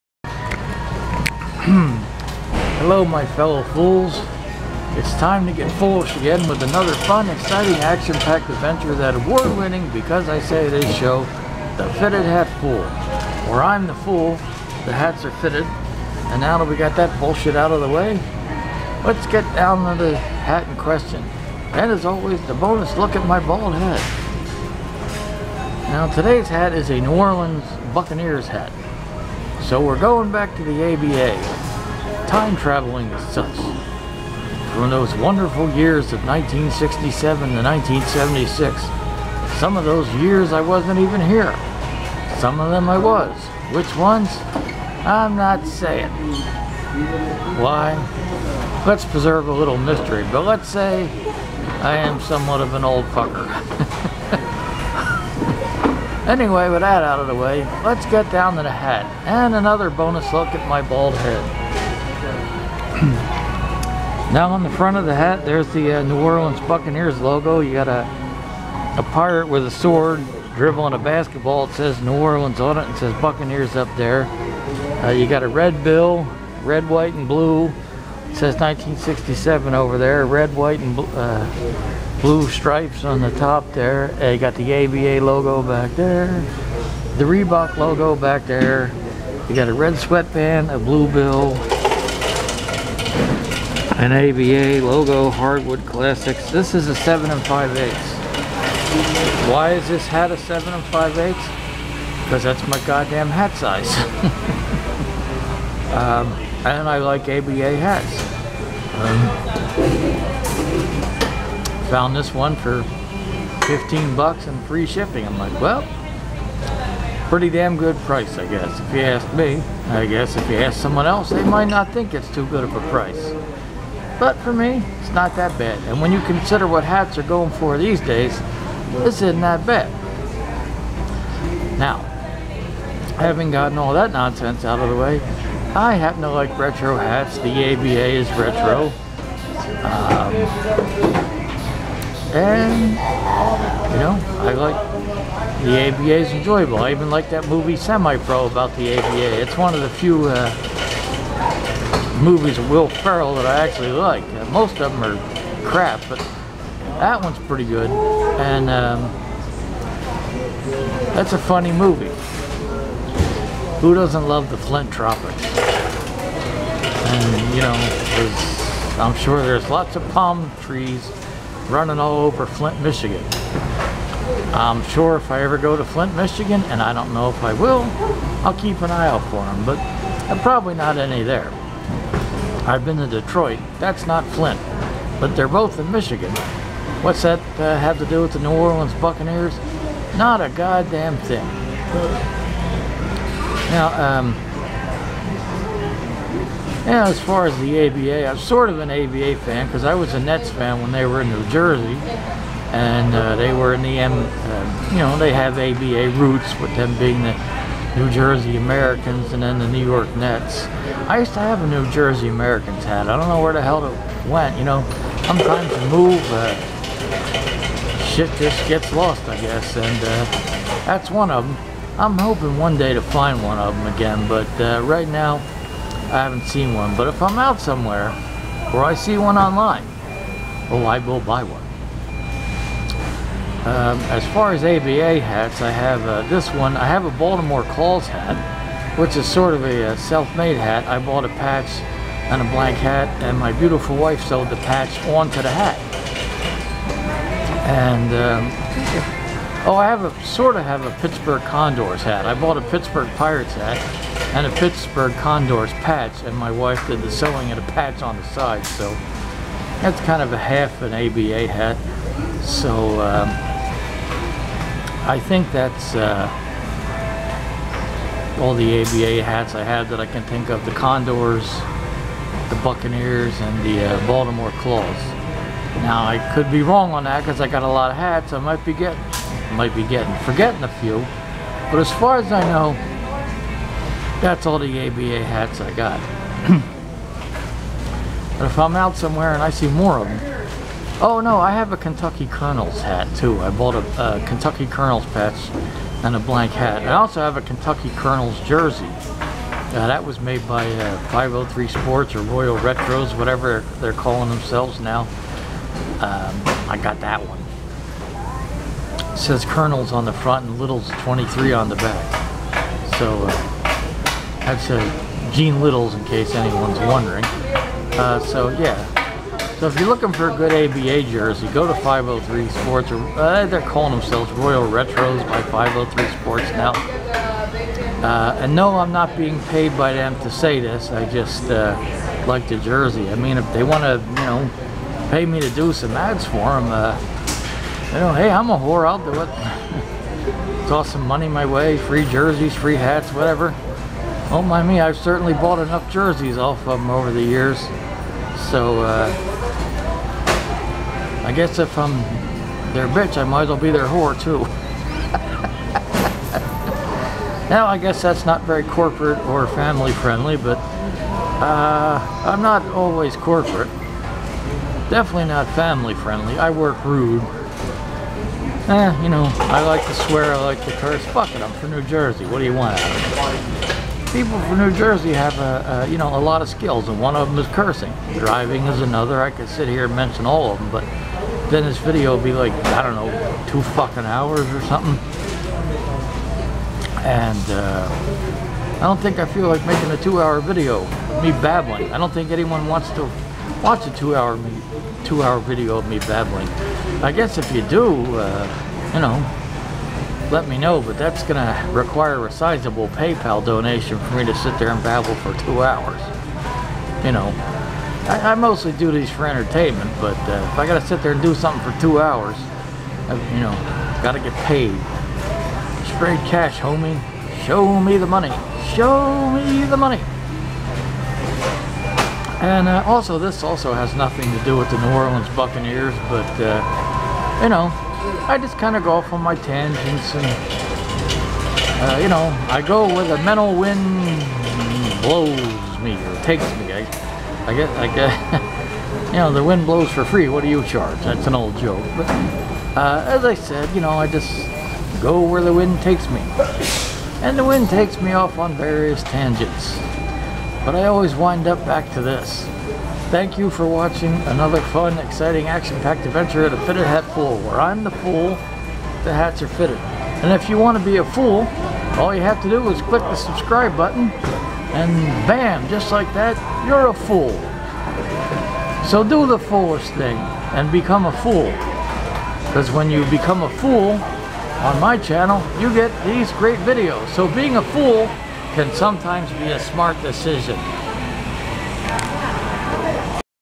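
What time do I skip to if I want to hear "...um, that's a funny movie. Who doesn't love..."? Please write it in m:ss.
2:38.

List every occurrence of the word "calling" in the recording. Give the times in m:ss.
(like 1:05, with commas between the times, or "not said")
5:03, 5:23.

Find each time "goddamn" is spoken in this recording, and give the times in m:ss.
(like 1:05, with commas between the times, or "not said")
1:42, 3:10.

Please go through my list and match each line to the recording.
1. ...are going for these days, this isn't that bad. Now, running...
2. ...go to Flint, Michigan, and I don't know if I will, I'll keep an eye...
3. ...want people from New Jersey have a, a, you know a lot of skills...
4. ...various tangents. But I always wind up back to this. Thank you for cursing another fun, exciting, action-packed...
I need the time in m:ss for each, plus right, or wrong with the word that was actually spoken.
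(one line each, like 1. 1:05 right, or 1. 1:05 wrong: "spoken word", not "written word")
1. 2:07 wrong: "having", not "running"
2. 2:55 right
3. 6:12 right
4. 7:28 wrong: "watching", not "cursing".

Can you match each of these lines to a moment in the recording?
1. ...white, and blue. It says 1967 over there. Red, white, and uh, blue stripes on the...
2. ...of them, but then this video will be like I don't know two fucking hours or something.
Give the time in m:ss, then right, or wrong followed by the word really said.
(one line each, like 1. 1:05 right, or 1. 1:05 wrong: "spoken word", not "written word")
1. 1:16 right
2. 6:20 right.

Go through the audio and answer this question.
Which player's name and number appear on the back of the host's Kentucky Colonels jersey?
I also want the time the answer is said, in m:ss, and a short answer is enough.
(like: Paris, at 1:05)
Gene Littles, at 5:15.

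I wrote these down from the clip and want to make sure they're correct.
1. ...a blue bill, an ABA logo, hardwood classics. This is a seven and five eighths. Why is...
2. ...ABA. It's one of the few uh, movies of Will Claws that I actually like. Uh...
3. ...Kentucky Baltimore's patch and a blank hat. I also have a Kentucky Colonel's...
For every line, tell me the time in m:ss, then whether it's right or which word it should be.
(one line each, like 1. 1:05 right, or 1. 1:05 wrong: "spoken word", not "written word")
1. 1:30 right
2. 2:28 wrong: "Ferrell", not "Claws"
3. 4:54 wrong: "Colonel", not "Baltimore".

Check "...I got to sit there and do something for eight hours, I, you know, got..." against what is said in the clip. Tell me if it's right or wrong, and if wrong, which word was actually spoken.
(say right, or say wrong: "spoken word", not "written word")
wrong: "two", not "eight".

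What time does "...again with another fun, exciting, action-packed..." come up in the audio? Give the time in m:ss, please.
0:06.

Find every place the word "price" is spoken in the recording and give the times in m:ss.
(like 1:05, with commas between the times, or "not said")
1:58, 2:02.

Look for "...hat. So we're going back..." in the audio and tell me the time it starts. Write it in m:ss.
0:28.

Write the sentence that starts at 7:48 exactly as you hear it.
So do the foolish thing, and become a fool.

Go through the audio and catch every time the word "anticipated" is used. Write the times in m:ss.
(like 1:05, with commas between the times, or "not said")
not said.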